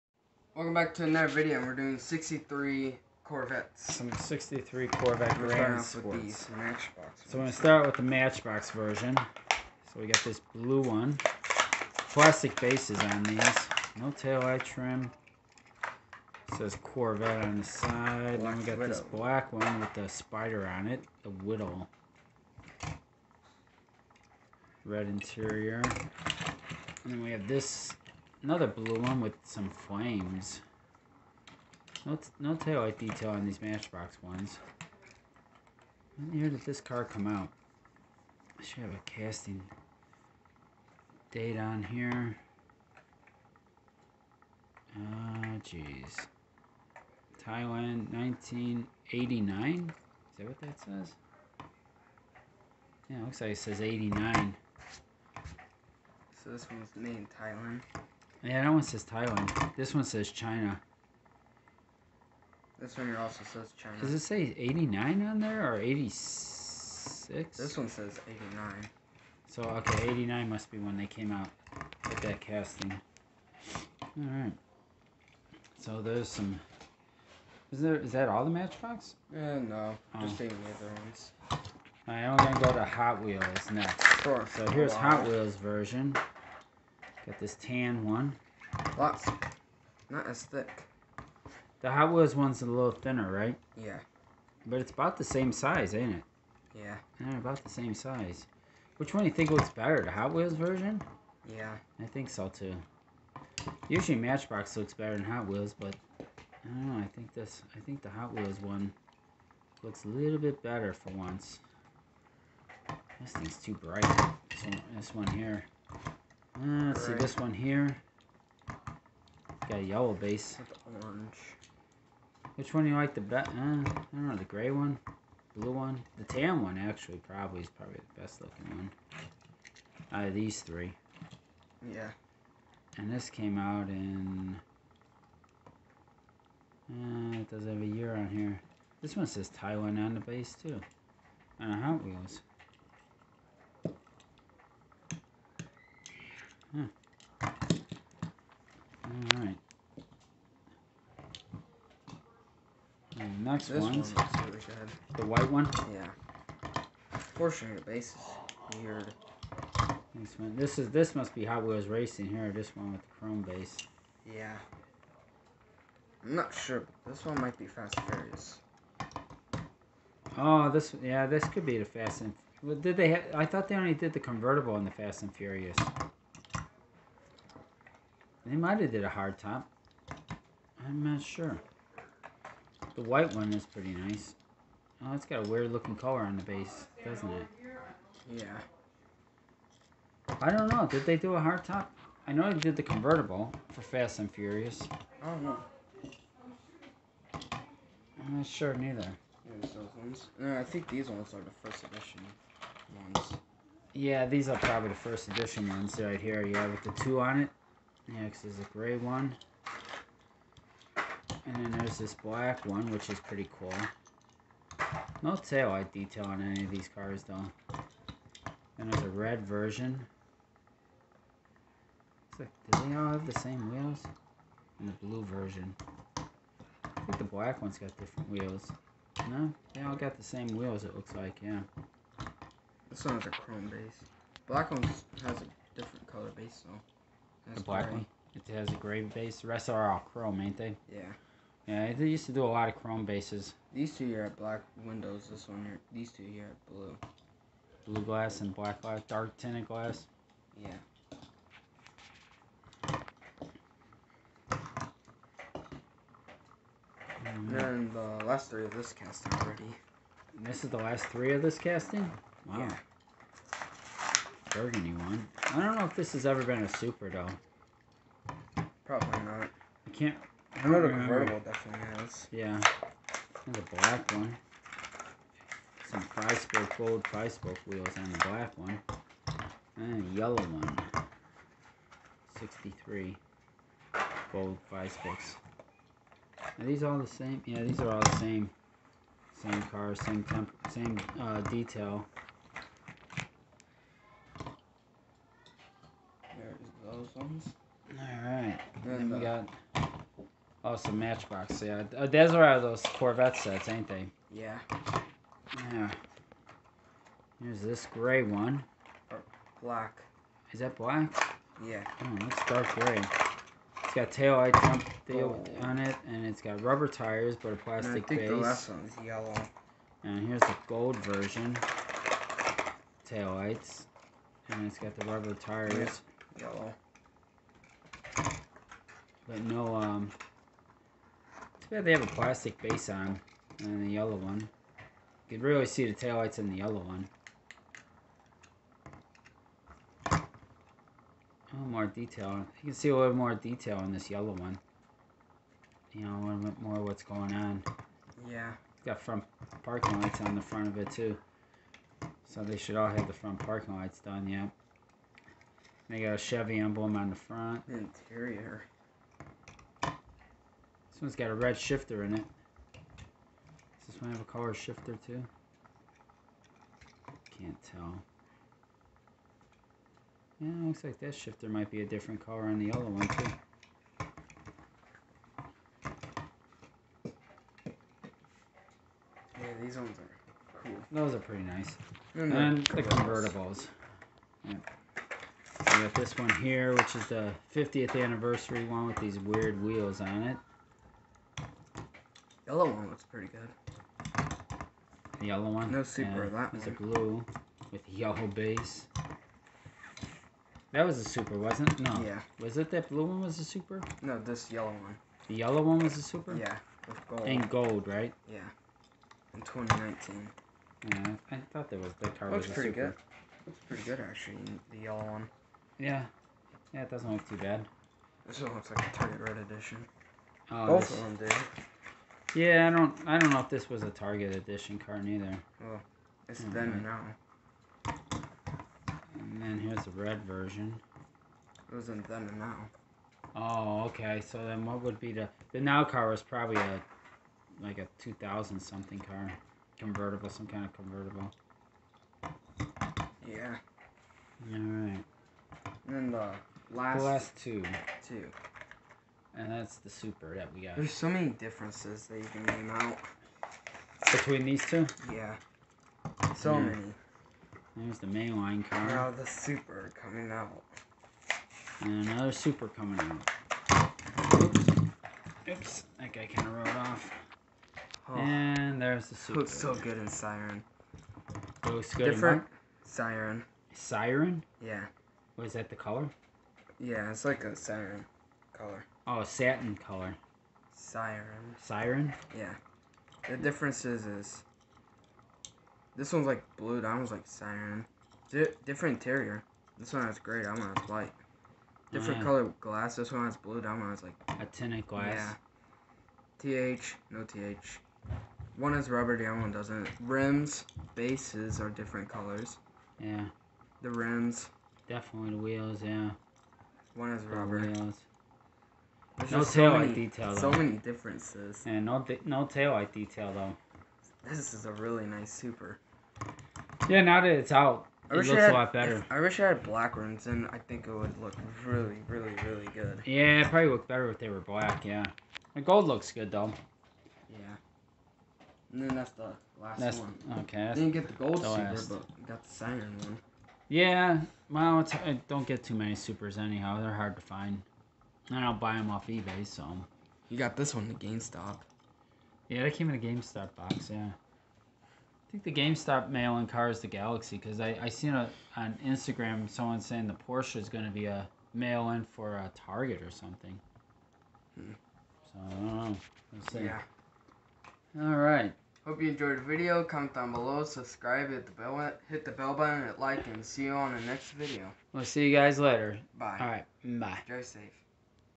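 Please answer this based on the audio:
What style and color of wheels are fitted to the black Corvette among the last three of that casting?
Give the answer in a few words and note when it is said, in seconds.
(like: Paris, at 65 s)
Gold tri-spoke, at 276 s.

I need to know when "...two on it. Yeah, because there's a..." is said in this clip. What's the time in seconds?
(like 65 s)
206 s.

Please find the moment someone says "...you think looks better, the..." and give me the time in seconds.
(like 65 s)
99 s.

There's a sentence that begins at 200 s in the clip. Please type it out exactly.
No, I think these ones are the first edition ones.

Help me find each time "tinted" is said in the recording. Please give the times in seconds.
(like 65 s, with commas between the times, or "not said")
249 s, 494 s.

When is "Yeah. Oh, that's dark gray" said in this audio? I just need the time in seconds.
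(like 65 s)
311 s.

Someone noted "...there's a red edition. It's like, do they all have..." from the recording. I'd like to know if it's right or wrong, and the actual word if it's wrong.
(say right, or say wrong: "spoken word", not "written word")
wrong: "version", not "edition".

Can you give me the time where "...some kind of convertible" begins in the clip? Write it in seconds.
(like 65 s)
440 s.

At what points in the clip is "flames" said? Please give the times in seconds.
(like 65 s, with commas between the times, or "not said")
29 s.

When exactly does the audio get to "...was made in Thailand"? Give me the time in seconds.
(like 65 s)
56 s.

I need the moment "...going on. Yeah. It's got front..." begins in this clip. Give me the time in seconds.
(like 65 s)
347 s.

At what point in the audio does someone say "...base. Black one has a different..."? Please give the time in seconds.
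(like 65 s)
233 s.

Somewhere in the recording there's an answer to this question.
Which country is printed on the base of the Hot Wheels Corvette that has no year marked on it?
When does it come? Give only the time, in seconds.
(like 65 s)
139 s.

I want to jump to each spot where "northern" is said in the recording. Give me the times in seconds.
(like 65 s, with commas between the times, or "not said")
not said.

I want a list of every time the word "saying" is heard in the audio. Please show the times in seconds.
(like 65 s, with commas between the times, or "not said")
549 s.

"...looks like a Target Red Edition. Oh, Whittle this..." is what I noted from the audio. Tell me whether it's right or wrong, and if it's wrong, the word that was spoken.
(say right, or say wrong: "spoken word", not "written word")
wrong: "Both", not "Whittle".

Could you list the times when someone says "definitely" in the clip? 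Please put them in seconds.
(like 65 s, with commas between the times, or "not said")
271 s, 504 s.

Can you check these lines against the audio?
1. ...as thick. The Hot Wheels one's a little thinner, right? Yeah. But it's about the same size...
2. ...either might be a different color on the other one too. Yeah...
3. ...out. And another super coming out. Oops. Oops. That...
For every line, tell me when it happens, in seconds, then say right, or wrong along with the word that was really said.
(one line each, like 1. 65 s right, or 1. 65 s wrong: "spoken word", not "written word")
1. 90 s right
2. 371 s wrong: "shifter", not "either"
3. 460 s right.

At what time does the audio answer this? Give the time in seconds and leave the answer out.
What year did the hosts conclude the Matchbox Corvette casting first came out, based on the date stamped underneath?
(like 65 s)
70 s.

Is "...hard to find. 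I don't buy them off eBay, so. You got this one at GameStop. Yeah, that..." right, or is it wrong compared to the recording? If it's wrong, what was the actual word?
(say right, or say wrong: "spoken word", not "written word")
right.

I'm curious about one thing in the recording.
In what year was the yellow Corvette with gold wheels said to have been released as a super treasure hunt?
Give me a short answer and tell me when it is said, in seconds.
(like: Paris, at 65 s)
2019, at 409 s.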